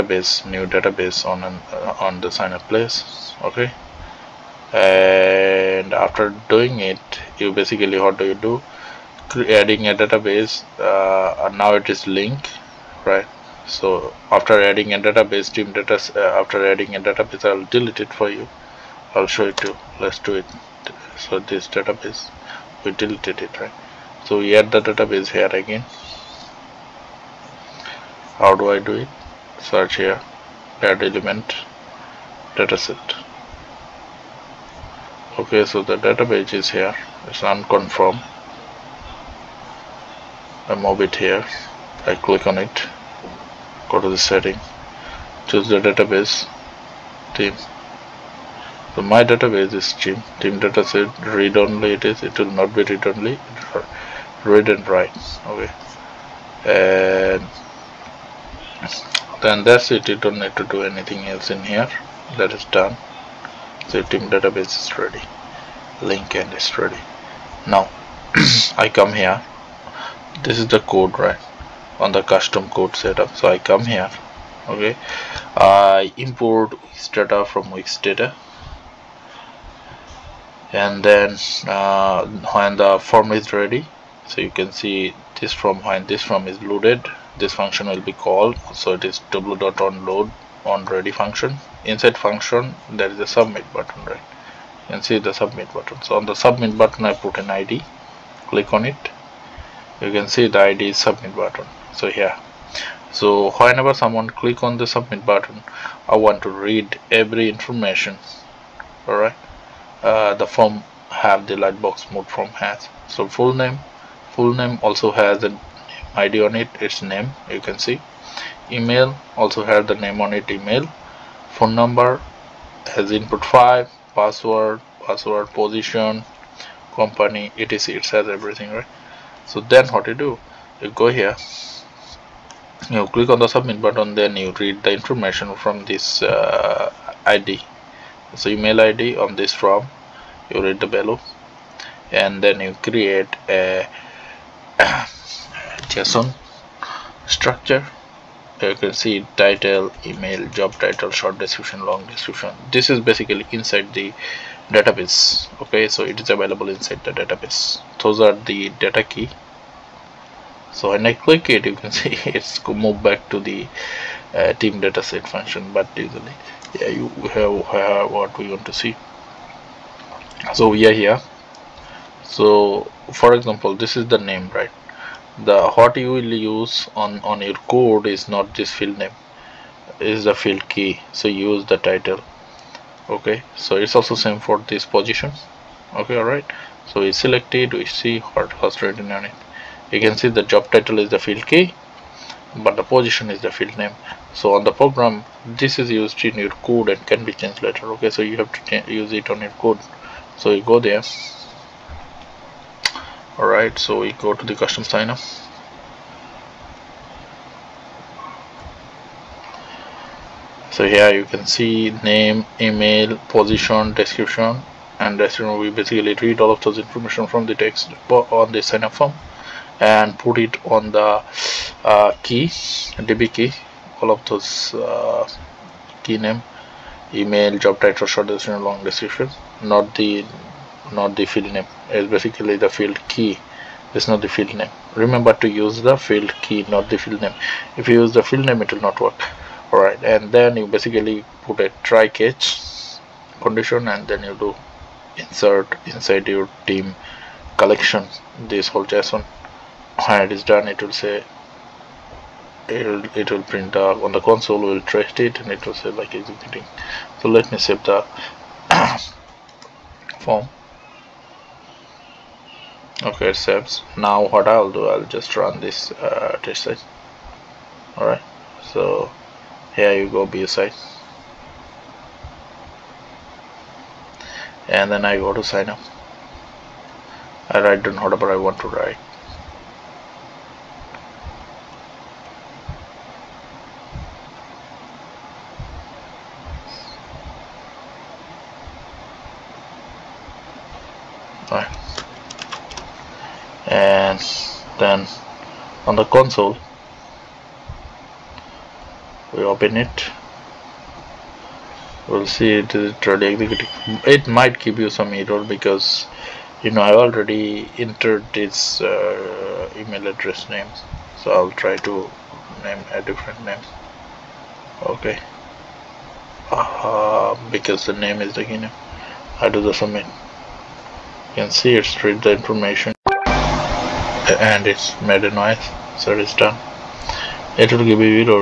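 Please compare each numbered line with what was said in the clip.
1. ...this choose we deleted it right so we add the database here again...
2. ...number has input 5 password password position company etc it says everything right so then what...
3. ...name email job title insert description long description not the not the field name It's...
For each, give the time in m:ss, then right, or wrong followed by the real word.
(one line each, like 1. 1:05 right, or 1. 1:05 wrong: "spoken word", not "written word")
1. 0:21 wrong: "database", not "choose"
2. 2:01 right
3. 3:46 wrong: "short", not "insert".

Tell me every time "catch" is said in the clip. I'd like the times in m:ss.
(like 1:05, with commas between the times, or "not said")
4:02.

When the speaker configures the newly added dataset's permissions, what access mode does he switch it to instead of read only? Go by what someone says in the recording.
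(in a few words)
read and write.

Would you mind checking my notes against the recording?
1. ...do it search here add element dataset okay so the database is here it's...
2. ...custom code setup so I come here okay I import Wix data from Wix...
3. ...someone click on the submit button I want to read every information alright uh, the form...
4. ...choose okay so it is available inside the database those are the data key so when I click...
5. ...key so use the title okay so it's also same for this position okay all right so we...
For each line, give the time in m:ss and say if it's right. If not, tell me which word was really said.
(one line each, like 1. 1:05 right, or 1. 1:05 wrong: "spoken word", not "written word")
1. 0:28 right
2. 1:12 right
3. 1:43 right
4. 2:34 wrong: "database", not "choose"
5. 3:00 right.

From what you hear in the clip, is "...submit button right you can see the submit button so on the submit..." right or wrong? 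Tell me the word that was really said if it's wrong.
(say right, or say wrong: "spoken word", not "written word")
right.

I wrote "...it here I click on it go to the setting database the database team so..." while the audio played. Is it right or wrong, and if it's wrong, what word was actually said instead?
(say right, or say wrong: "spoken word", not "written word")
wrong: "choose", not "database".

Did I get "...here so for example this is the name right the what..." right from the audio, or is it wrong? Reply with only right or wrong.
right.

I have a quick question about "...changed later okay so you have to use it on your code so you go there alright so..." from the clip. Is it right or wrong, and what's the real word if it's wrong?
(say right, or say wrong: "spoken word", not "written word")
right.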